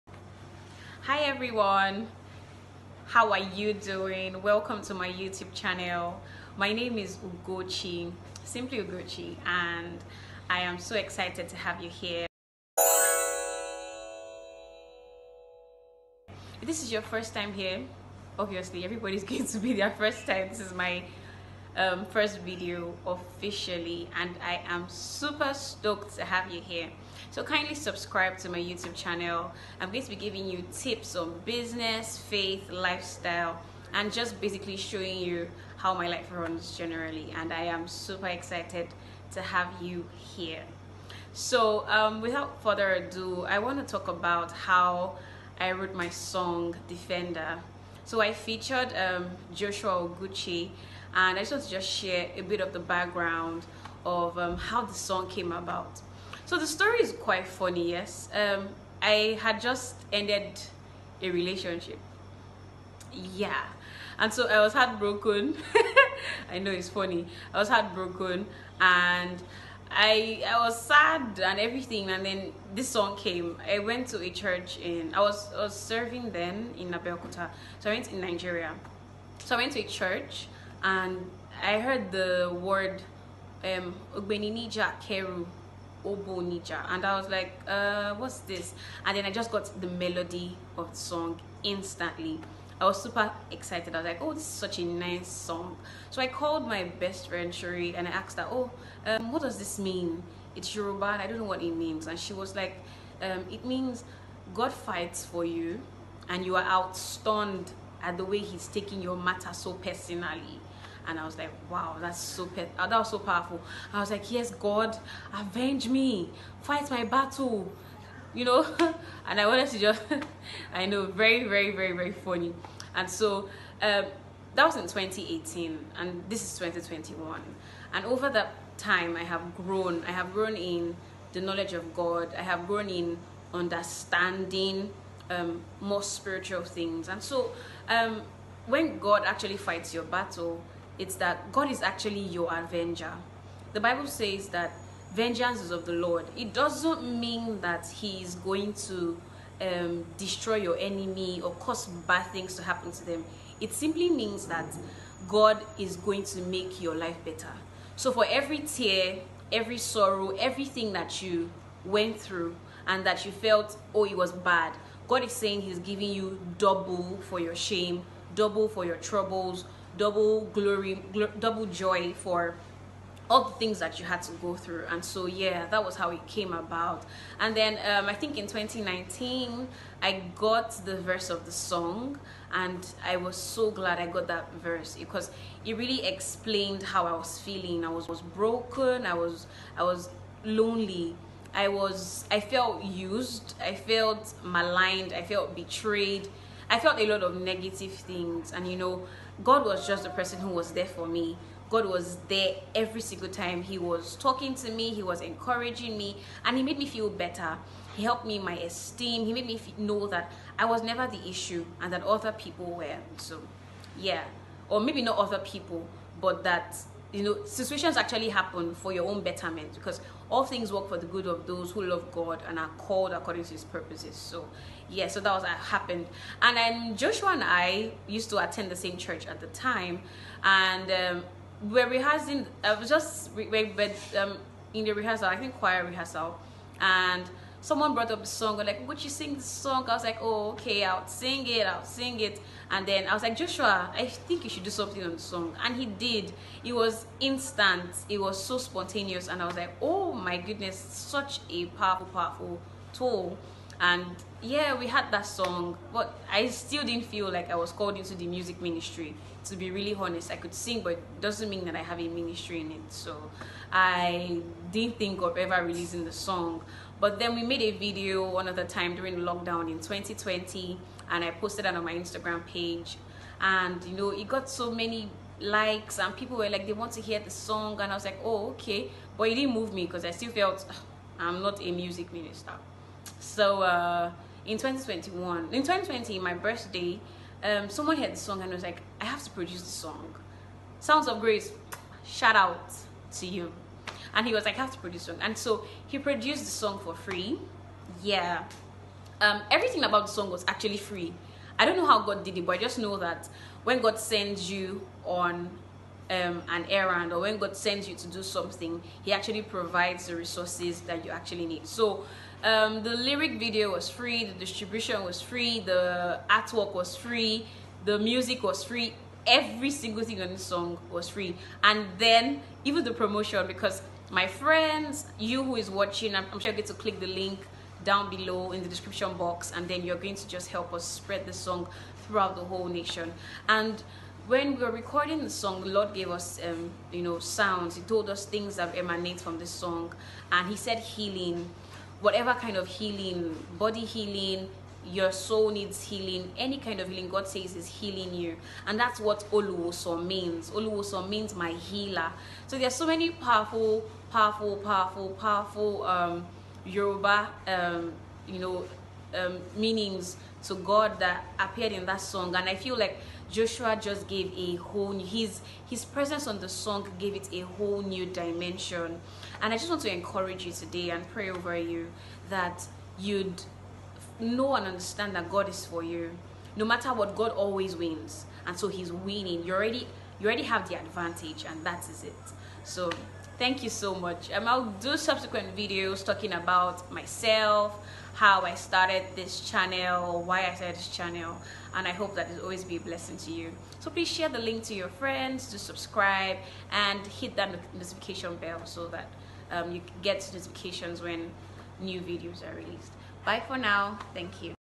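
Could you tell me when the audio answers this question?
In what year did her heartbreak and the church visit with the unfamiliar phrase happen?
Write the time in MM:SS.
02:04.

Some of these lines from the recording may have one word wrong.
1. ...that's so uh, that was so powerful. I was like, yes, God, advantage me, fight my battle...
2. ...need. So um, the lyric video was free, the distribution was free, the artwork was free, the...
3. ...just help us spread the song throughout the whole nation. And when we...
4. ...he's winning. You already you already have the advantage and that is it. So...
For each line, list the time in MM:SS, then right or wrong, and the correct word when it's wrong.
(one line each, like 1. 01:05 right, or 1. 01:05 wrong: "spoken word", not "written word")
1. 01:51 wrong: "avenge", not "advantage"
2. 05:11 right
3. 05:30 right
4. 06:18 right.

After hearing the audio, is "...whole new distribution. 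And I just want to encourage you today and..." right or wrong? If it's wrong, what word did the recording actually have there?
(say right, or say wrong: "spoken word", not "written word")
wrong: "dimension", not "distribution".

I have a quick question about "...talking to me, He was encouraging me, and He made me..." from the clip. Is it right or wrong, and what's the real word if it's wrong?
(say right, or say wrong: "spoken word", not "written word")
right.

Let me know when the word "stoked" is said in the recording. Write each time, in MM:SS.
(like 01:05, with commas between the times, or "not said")
00:25.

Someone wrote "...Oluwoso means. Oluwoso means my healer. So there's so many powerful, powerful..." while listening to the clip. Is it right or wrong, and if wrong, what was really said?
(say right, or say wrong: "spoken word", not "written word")
right.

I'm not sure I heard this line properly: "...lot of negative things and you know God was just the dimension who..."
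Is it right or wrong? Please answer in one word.
wrong.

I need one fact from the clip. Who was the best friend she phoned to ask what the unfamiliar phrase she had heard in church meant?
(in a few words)
Shuri.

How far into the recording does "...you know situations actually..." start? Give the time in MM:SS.
03:37.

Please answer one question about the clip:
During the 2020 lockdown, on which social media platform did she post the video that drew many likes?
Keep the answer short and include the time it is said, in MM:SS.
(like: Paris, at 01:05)
Instagram, at 04:31.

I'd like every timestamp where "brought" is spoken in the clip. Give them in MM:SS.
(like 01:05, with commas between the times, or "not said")
03:57.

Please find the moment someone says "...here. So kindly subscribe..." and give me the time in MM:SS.
00:26.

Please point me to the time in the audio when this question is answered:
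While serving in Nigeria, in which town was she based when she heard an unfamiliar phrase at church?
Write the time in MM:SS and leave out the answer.
01:16.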